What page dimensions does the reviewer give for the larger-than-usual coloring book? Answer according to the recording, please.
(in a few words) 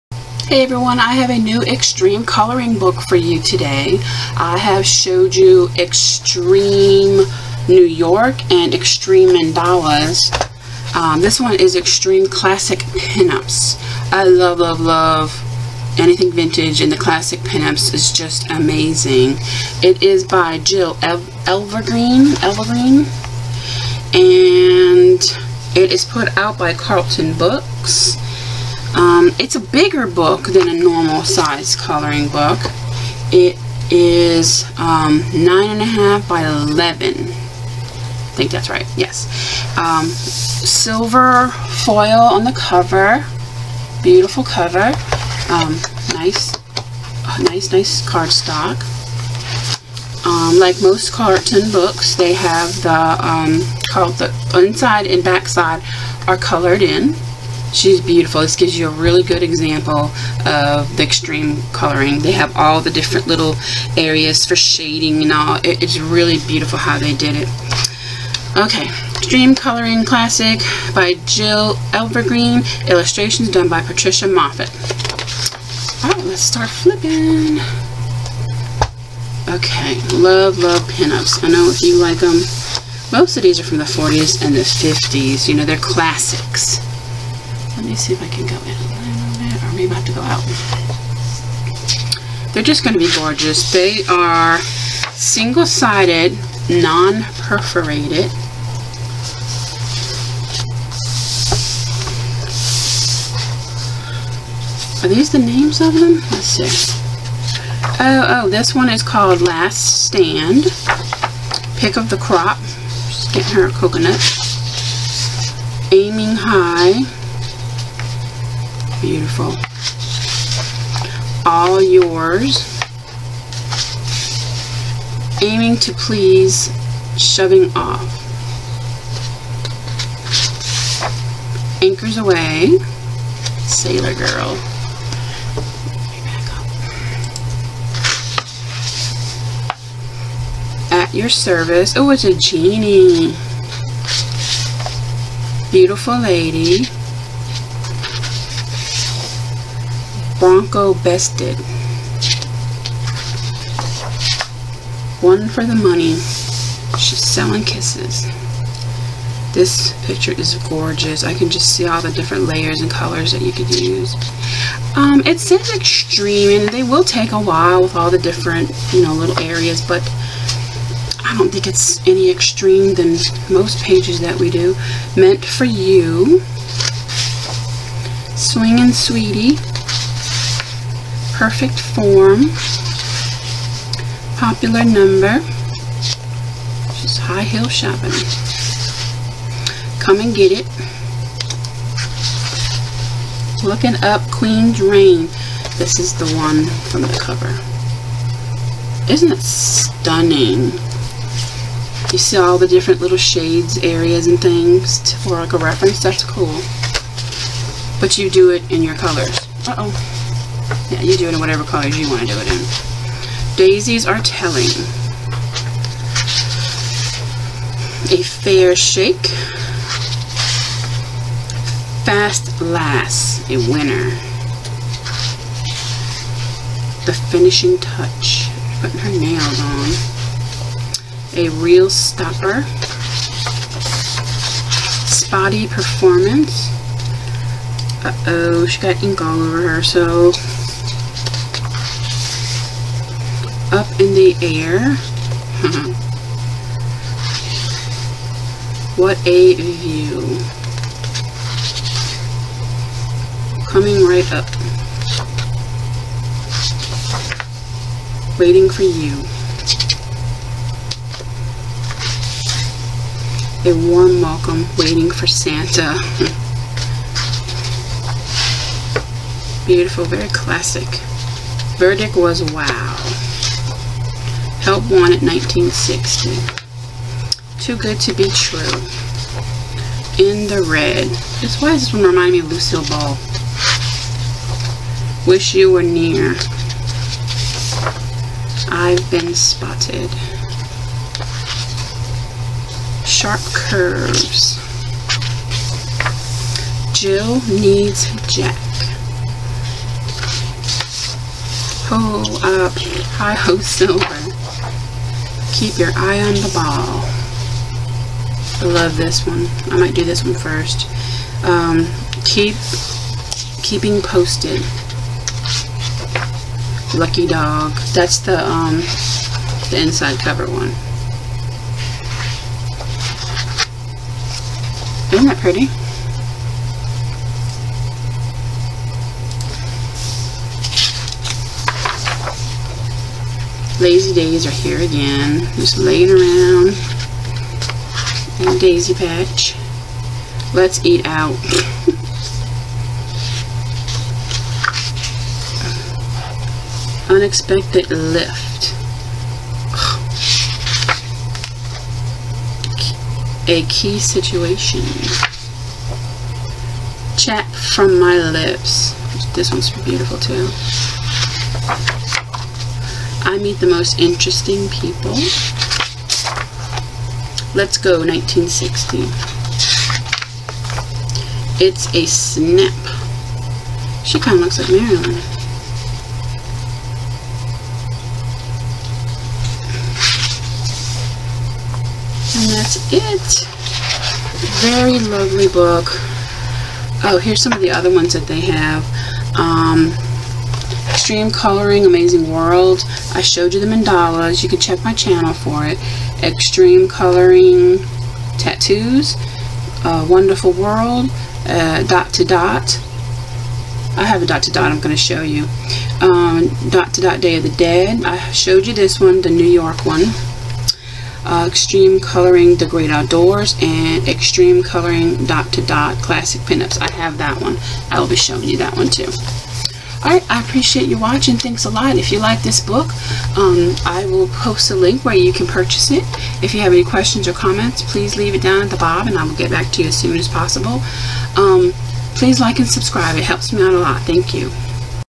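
9.5 by 11.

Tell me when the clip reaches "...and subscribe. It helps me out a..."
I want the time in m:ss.
7:12.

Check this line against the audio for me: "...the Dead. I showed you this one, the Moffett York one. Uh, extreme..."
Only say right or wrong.
wrong.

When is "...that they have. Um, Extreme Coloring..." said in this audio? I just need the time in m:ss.
6:28.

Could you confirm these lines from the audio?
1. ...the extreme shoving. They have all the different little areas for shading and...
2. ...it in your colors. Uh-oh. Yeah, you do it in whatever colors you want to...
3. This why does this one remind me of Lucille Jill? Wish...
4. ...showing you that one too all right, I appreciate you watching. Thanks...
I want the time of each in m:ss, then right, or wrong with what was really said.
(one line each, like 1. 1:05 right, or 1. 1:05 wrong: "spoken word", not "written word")
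1. 1:00 wrong: "coloring", not "shoving"
2. 3:28 right
3. 4:41 wrong: "Ball", not "Jill"
4. 6:58 right.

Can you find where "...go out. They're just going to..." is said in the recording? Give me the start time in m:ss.
1:30.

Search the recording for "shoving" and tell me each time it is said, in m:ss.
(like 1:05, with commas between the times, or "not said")
2:07.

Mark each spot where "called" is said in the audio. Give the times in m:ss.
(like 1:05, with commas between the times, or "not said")
0:53, 1:49.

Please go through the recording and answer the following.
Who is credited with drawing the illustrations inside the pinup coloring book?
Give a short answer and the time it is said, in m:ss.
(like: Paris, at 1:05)
Patricia Moffett, at 1:13.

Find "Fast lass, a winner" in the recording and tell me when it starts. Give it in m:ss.
3:42.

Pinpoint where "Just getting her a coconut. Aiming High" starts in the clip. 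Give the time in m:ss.
1:53.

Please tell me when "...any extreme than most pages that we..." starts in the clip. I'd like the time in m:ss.
2:52.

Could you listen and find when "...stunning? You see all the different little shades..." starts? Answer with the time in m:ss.
3:19.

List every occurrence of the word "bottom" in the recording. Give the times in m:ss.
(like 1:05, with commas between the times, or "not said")
7:08.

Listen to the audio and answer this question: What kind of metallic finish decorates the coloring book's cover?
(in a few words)
Silver foil.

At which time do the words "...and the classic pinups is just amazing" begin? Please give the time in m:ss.
0:16.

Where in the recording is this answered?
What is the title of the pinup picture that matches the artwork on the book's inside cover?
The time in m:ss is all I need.
5:16.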